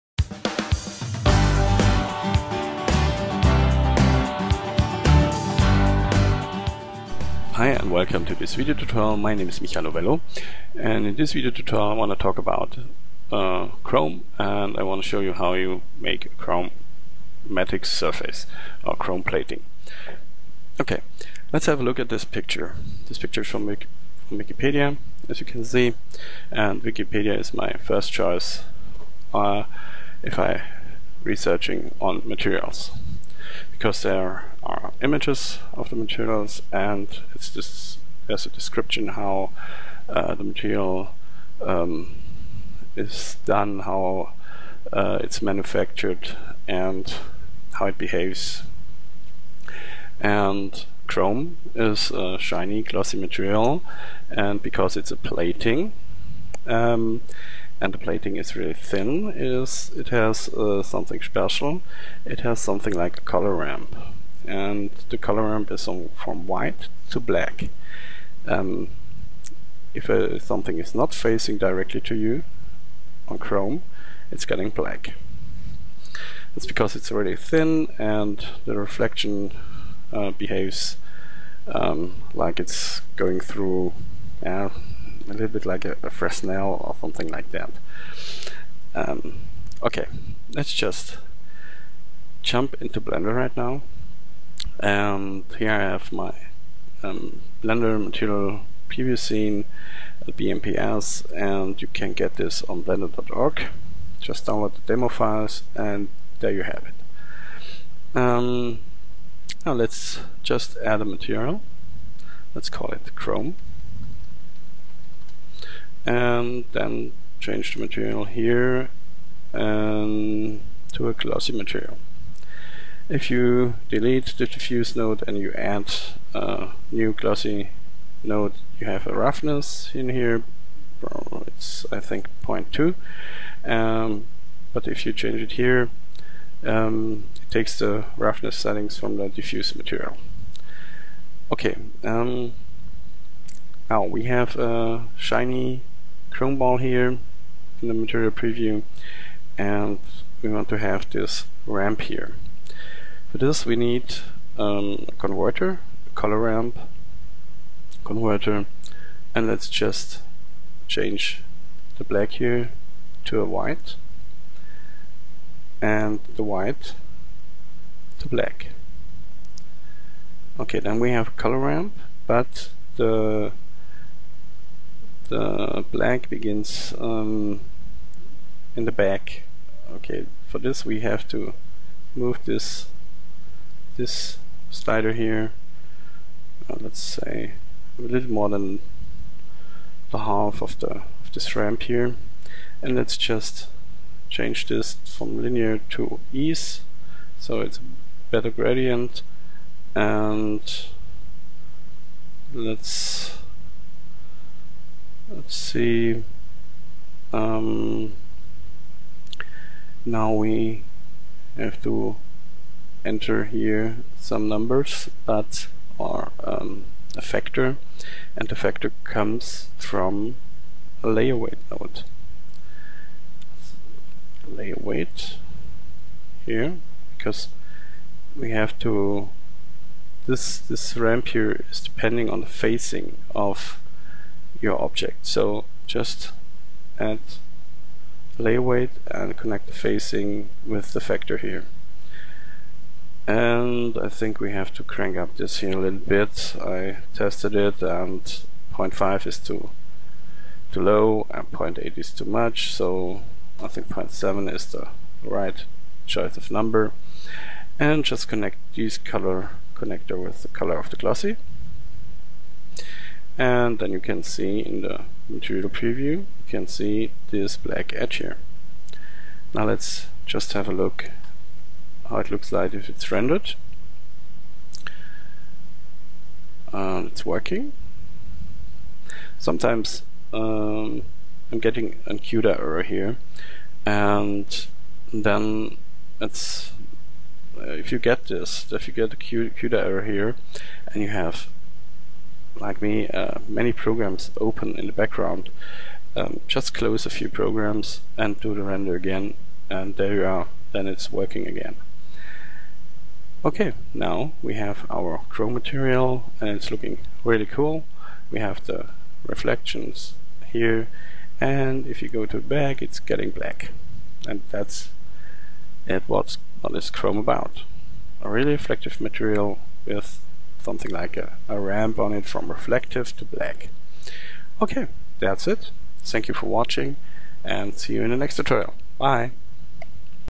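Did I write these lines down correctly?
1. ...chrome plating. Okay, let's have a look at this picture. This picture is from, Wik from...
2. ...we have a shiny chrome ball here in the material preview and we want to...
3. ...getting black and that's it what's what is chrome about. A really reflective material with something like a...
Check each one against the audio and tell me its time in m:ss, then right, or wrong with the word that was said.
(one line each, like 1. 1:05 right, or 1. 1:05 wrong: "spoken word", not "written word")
1. 0:18 right
2. 2:24 right
3. 5:12 right.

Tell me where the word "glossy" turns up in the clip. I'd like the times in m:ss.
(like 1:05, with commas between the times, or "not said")
0:52, 2:01, 2:07, 4:20.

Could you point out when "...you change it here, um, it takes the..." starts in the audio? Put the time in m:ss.
2:15.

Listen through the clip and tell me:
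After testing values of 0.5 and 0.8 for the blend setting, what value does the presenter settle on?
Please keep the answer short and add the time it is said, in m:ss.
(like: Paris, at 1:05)
0.7, at 4:13.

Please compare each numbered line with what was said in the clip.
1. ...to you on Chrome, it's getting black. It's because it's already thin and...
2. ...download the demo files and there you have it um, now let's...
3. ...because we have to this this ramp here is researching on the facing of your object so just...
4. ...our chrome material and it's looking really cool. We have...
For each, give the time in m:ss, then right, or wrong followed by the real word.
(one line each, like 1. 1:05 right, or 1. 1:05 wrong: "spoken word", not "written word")
1. 1:12 right
2. 1:44 right
3. 3:47 wrong: "depending", not "researching"
4. 5:04 right.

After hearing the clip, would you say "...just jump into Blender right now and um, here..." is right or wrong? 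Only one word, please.
right.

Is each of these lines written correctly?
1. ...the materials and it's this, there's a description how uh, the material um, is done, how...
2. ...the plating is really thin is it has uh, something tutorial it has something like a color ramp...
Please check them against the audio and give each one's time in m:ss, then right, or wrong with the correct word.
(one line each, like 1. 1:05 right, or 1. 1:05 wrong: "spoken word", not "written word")
1. 0:35 right
2. 0:57 wrong: "special", not "tutorial".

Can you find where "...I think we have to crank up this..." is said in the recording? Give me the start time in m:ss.
4:03.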